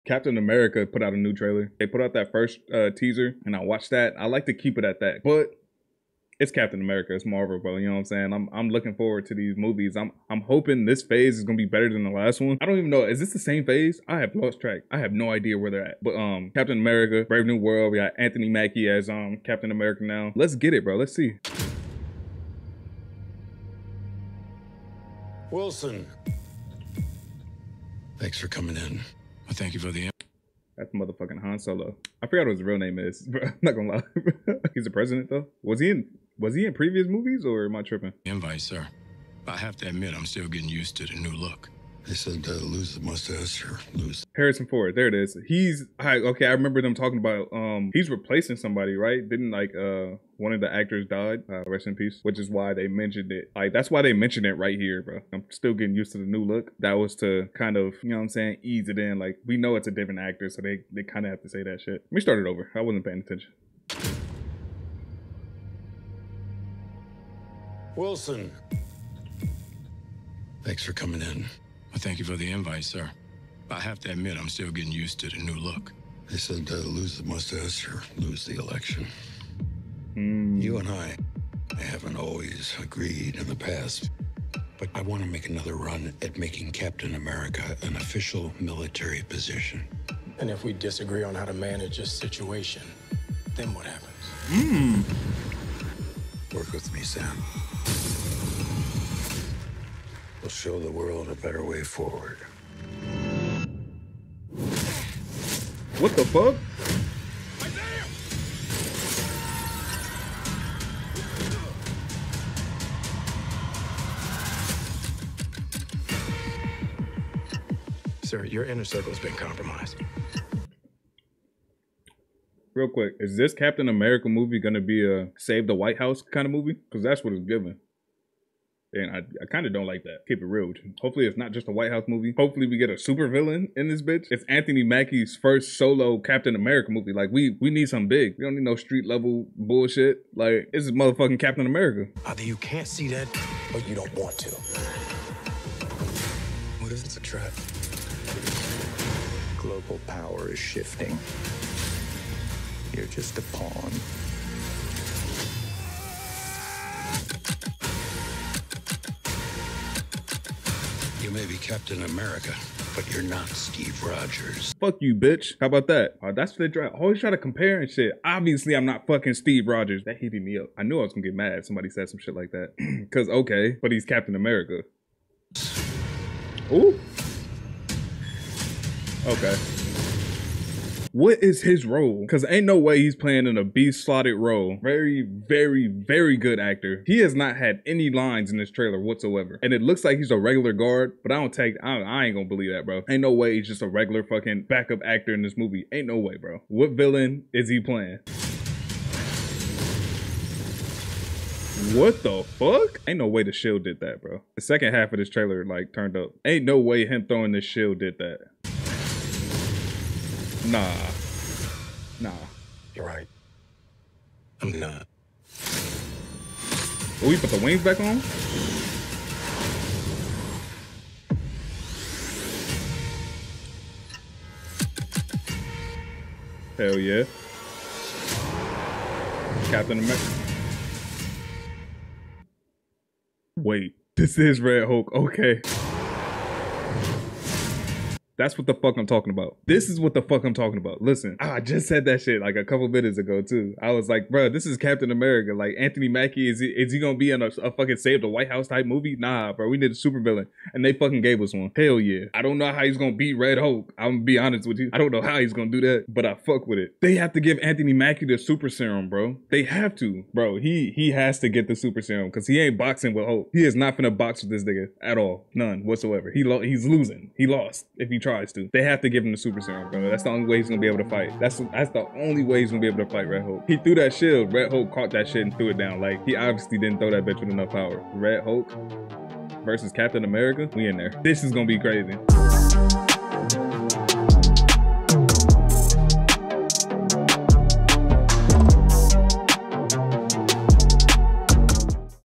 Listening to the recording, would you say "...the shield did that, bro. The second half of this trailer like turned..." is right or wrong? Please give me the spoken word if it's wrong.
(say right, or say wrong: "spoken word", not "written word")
right.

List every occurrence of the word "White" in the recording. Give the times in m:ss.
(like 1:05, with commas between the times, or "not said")
2:05, 2:11, 4:08.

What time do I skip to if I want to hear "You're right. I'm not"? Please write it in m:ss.
3:32.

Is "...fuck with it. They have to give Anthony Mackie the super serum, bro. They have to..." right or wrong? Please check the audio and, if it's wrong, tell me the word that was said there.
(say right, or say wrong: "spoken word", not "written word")
right.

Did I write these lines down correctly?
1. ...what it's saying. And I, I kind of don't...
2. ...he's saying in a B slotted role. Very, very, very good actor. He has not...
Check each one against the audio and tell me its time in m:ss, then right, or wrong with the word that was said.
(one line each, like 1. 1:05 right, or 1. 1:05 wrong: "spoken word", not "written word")
1. 2:07 wrong: "giving", not "saying"
2. 3:02 wrong: "playing", not "saying".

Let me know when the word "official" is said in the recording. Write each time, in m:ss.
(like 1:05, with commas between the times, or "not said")
1:27.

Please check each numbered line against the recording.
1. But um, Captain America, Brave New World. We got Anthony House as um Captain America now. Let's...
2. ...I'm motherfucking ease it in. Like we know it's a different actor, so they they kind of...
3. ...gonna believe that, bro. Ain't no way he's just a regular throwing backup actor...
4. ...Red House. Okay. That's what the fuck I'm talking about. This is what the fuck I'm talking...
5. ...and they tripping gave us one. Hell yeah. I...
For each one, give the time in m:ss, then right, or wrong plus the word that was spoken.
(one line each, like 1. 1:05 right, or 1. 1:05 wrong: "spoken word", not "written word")
1. 0:16 wrong: "Mackie", not "House"
2. 0:58 wrong: "saying", not "motherfucking"
3. 3:12 wrong: "fucking", not "throwing"
4. 3:54 wrong: "Hulk", not "House"
5. 4:10 wrong: "fucking", not "tripping".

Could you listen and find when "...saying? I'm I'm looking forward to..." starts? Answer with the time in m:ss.
0:08.